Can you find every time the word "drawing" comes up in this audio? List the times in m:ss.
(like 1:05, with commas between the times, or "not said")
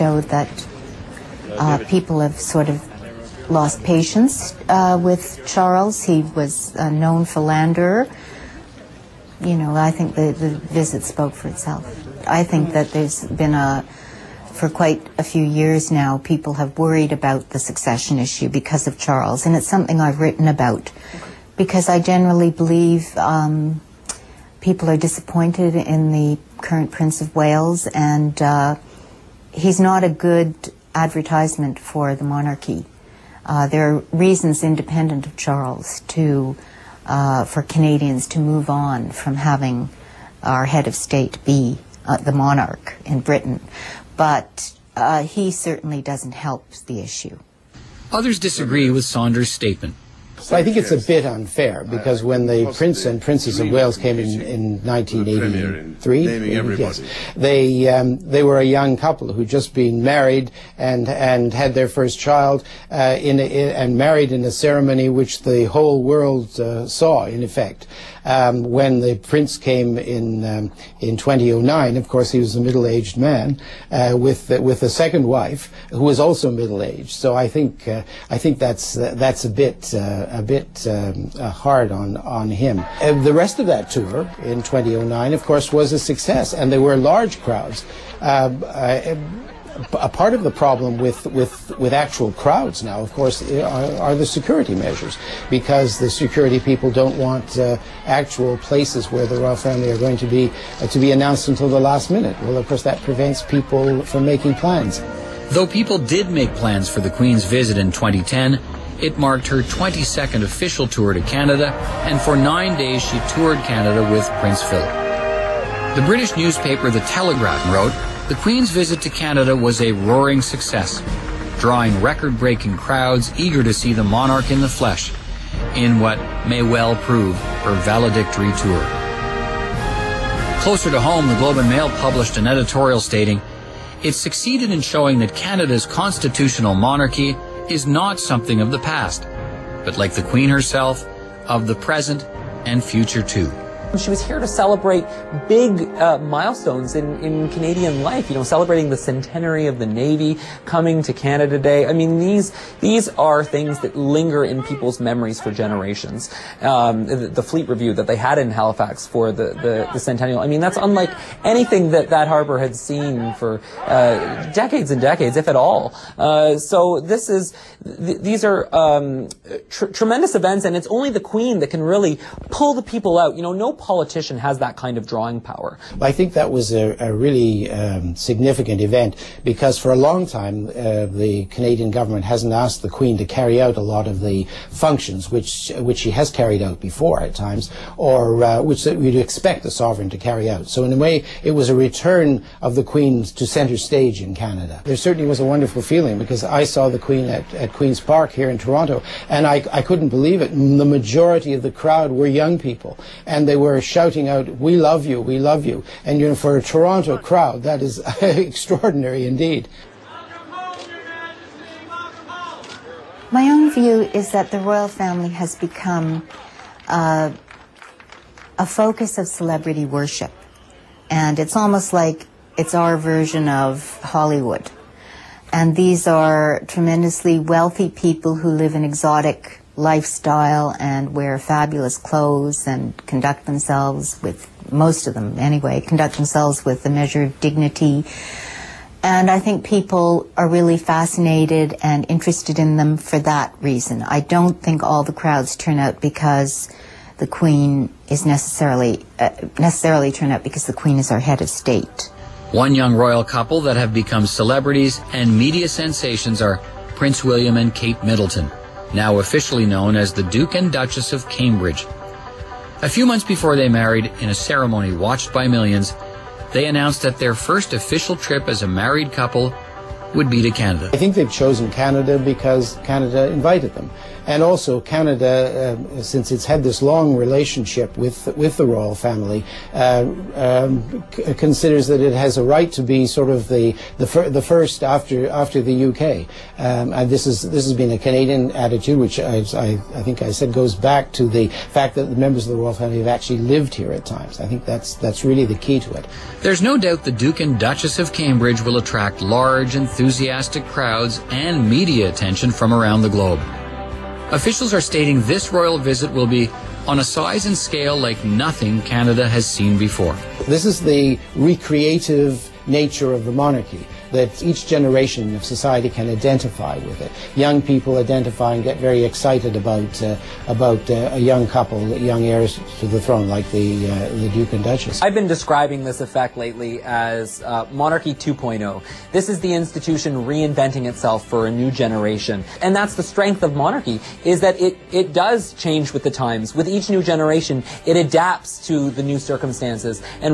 2:01, 2:55.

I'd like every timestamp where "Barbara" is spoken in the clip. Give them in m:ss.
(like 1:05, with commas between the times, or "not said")
not said.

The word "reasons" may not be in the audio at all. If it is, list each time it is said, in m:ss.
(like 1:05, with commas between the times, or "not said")
0:34, 4:03.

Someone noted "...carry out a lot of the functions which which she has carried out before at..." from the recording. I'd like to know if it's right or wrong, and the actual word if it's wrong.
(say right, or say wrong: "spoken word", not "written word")
right.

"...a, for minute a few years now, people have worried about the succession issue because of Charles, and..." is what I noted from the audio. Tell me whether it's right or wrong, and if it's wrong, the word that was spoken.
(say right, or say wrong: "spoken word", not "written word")
wrong: "quite", not "minute".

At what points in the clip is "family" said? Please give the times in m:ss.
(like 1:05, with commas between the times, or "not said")
1:39, 3:34, 4:38, 4:52.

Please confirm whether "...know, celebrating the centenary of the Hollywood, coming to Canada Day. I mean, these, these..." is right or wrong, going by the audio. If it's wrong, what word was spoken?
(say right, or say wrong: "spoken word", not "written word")
wrong: "Navy", not "Hollywood".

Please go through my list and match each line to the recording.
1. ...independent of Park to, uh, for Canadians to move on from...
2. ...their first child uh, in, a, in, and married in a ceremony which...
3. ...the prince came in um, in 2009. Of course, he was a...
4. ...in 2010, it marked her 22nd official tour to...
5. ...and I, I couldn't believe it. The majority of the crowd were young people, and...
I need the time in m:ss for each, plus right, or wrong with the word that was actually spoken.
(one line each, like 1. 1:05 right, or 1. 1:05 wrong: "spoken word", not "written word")
1. 0:34 wrong: "Charles", not "Park"
2. 1:01 right
3. 1:08 right
4. 1:47 right
5. 3:19 right.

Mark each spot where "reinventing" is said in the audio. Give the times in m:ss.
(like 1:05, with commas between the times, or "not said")
5:30.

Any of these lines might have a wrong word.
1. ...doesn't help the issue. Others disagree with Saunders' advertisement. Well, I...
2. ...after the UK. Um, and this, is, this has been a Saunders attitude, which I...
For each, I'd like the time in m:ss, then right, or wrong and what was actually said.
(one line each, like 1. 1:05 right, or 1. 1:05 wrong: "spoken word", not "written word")
1. 0:46 wrong: "statement", not "advertisement"
2. 4:45 wrong: "Canadian", not "Saunders".